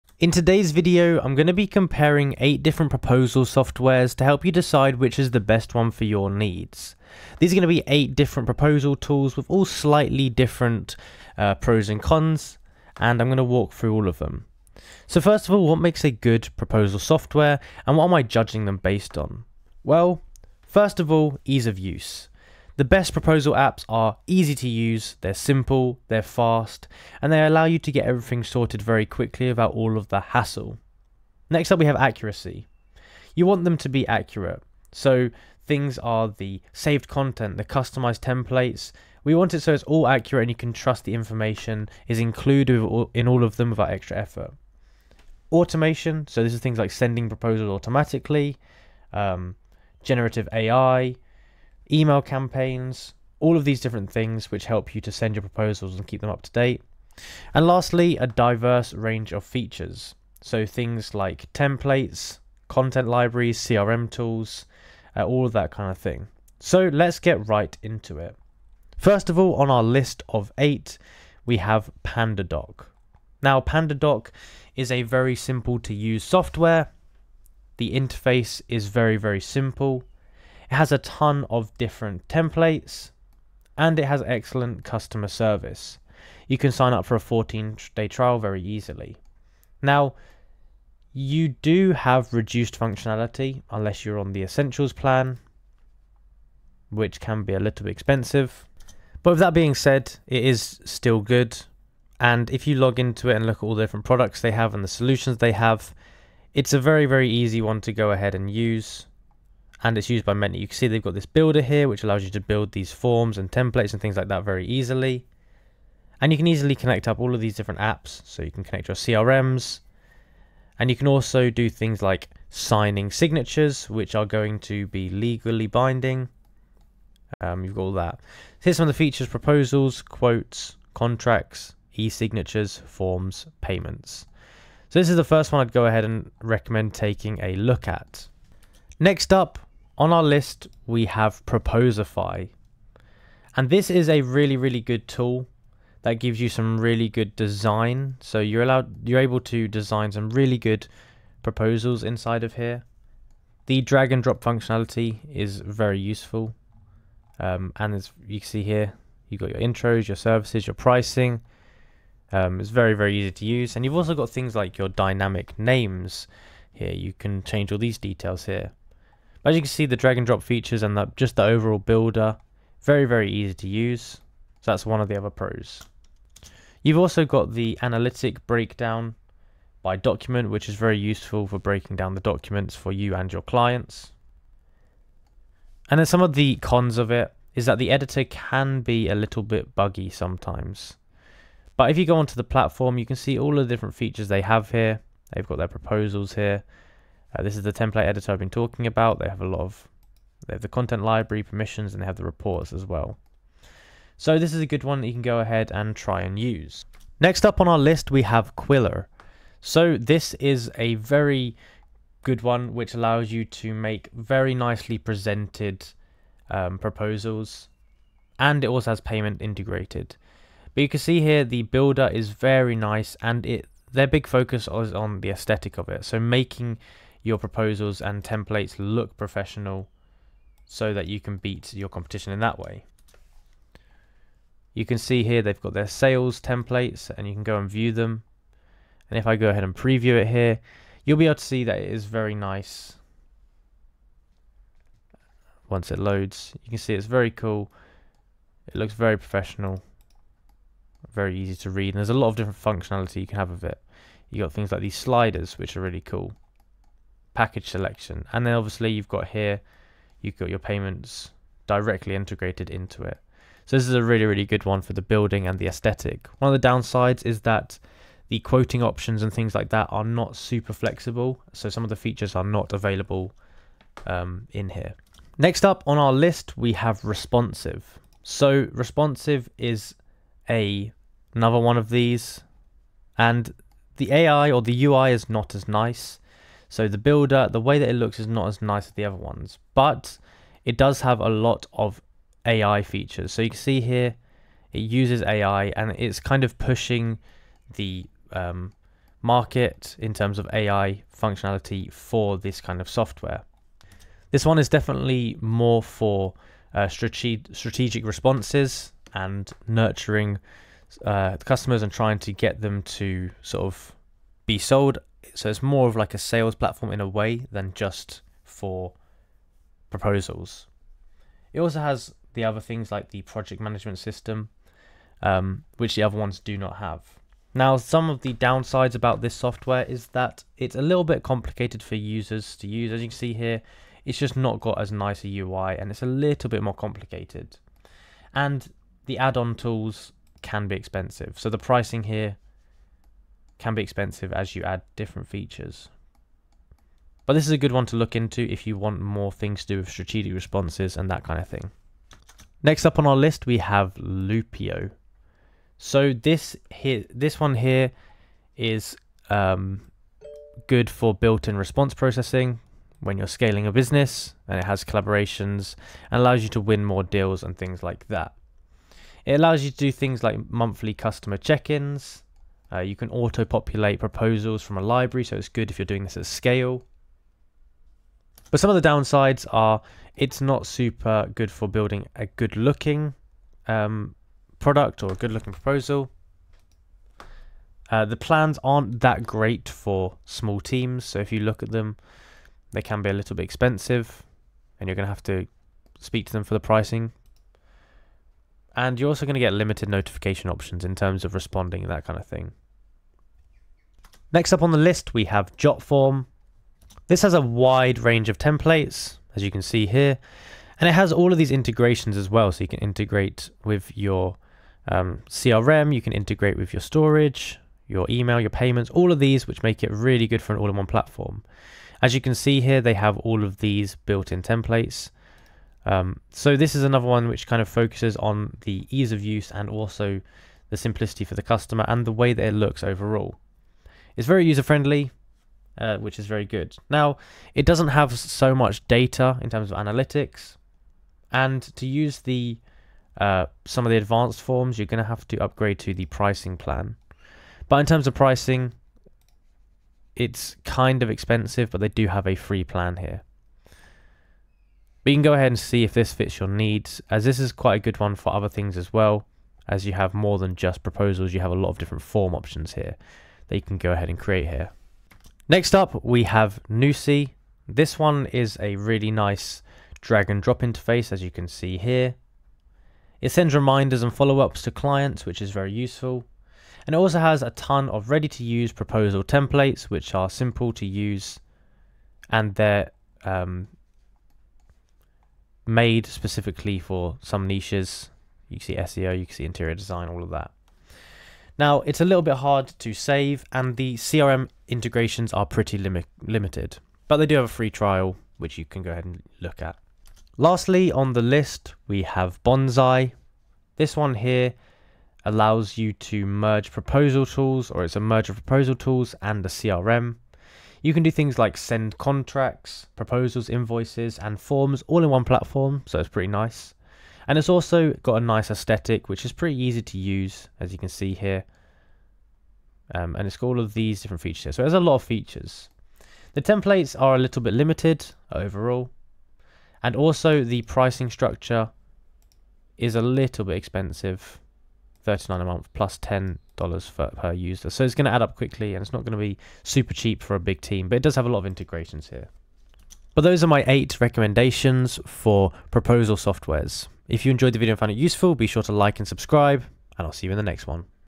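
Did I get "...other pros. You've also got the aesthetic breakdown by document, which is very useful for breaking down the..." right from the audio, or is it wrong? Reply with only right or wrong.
wrong.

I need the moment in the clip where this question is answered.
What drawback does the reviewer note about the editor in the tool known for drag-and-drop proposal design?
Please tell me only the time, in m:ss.
3:09.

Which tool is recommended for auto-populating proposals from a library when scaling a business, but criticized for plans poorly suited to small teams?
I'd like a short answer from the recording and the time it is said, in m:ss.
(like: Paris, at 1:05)
Loopio, at 5:53.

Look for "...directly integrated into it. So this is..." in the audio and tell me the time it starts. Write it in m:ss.
4:21.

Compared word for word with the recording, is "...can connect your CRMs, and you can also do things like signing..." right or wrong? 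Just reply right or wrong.
right.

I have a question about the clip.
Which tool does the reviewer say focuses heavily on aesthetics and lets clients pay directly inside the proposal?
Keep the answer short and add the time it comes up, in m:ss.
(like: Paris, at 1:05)
Qwilr, at 3:28.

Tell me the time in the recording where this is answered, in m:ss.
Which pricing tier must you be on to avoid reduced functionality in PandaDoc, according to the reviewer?
1:34.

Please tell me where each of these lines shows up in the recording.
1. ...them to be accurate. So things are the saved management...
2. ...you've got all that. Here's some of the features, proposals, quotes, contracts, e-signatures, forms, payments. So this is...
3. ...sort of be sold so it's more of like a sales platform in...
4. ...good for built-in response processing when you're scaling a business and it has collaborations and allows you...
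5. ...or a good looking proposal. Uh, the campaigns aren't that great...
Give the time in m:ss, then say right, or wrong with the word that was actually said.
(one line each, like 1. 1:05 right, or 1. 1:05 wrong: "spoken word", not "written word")
1. 0:33 wrong: "content", not "management"
2. 2:07 right
3. 5:13 right
4. 6:00 right
5. 6:25 wrong: "plans", not "campaigns".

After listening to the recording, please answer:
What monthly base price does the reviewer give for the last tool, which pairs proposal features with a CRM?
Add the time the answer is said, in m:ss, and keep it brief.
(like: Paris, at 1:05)
$39, at 8:55.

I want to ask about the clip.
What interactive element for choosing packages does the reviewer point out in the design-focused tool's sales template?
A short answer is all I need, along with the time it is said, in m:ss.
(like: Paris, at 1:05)
sliders, at 4:14.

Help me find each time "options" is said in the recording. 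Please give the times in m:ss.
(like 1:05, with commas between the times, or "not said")
4:28, 6:40, 7:42.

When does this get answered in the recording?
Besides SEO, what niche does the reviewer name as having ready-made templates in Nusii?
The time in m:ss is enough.
8:09.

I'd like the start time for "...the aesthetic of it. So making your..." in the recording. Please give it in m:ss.
3:45.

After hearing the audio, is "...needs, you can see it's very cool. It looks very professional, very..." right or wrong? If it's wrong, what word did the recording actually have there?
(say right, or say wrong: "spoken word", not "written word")
wrong: "loads", not "needs".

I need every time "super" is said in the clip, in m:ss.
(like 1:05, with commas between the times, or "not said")
4:30, 6:20, 8:59.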